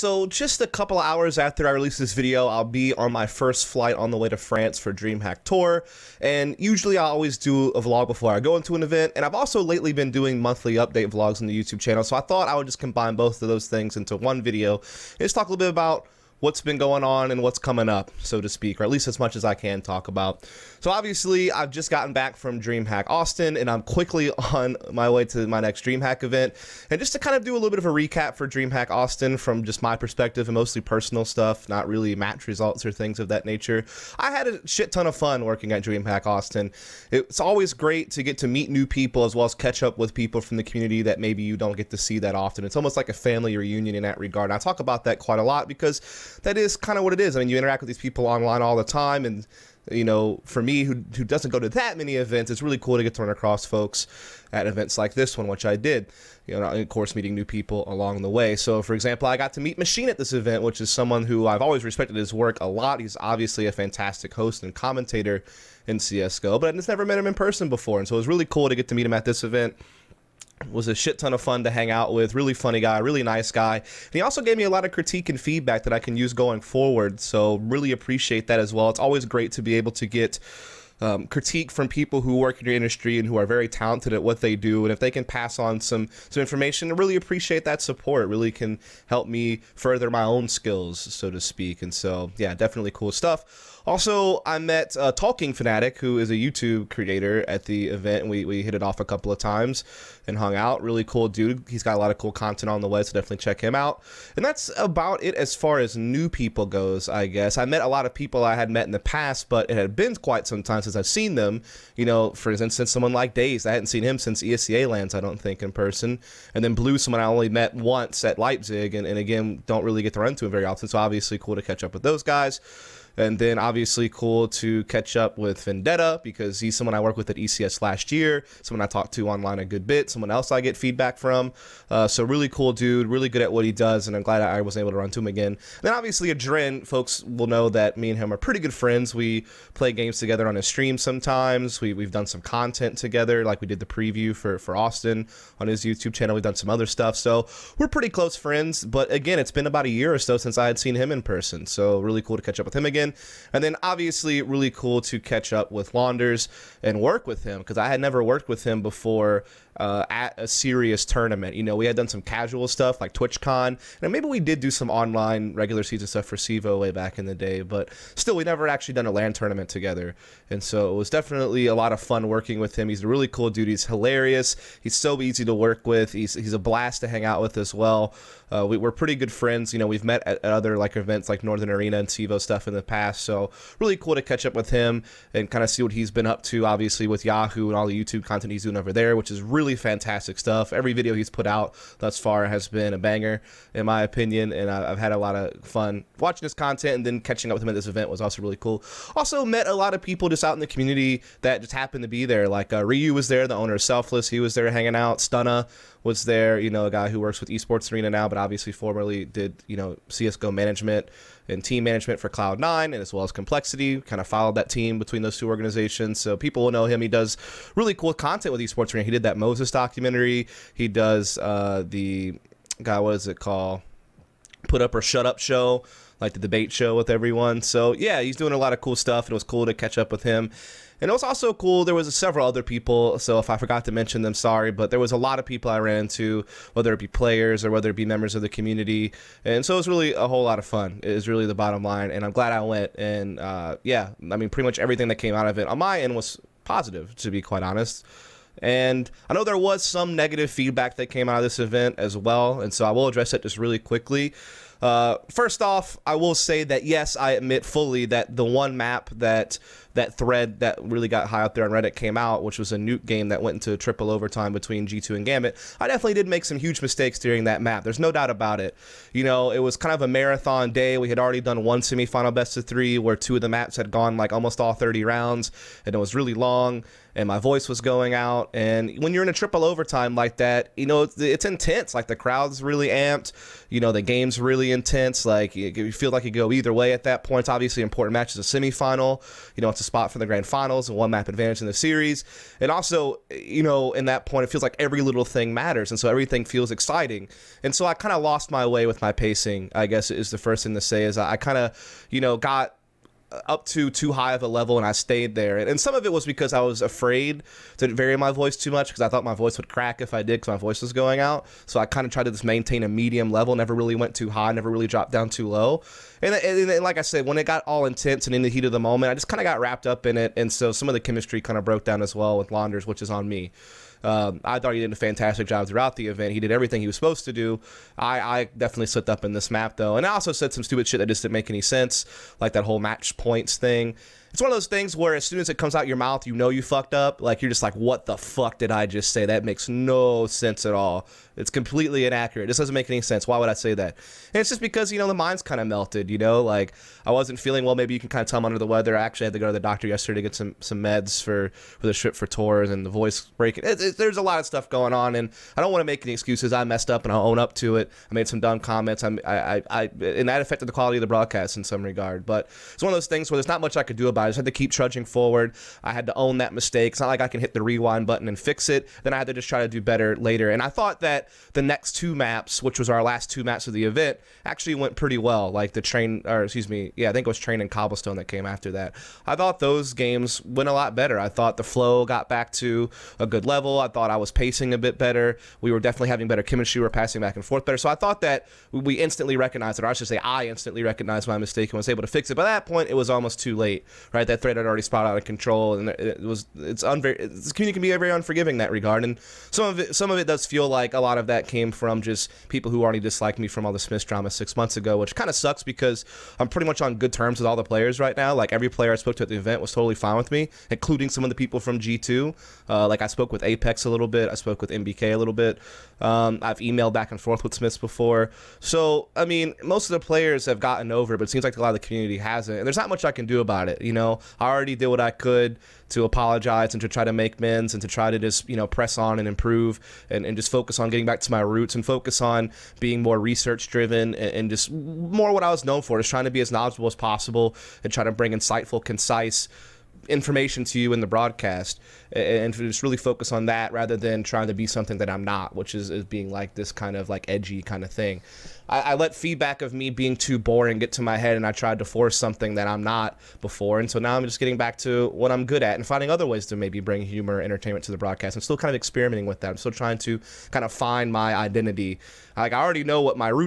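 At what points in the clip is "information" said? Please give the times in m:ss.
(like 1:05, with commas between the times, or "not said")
1:26, 7:20.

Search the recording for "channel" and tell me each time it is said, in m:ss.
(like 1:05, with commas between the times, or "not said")
0:11, 2:26.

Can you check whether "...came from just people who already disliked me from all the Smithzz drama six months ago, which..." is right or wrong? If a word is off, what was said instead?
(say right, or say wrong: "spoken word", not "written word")
right.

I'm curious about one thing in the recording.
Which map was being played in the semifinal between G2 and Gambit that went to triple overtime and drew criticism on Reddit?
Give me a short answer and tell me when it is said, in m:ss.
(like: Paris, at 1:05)
Nuke, at 4:22.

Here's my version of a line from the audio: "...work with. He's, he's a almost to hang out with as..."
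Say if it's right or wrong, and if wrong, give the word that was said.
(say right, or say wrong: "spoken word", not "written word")
wrong: "blast", not "almost".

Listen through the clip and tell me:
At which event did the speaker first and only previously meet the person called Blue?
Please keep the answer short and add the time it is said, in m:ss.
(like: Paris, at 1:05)
Leipzig, at 1:58.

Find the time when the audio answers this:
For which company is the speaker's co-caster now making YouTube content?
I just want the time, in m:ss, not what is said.
3:07.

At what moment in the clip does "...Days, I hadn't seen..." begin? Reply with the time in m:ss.
1:53.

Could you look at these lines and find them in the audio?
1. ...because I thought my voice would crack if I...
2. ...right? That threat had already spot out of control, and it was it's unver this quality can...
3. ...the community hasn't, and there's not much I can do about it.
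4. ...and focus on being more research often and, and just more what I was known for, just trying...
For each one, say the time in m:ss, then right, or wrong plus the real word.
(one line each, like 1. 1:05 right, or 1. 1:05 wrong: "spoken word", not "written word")
1. 5:08 right
2. 6:34 wrong: "community", not "quality"
3. 7:01 right
4. 7:11 wrong: "driven", not "often".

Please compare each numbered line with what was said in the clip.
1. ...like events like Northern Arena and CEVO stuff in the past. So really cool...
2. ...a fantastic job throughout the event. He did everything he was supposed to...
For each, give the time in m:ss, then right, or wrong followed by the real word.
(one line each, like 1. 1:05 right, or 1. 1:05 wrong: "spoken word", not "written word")
1. 3:00 right
2. 5:24 right.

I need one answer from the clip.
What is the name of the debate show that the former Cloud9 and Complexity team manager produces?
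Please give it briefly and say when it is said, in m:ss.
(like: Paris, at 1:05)
Put Up or Shut Up, at 3:44.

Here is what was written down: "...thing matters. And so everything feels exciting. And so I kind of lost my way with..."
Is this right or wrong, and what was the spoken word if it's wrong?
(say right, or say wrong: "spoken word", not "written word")
right.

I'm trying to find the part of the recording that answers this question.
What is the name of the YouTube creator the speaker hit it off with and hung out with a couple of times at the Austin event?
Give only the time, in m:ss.
1:35.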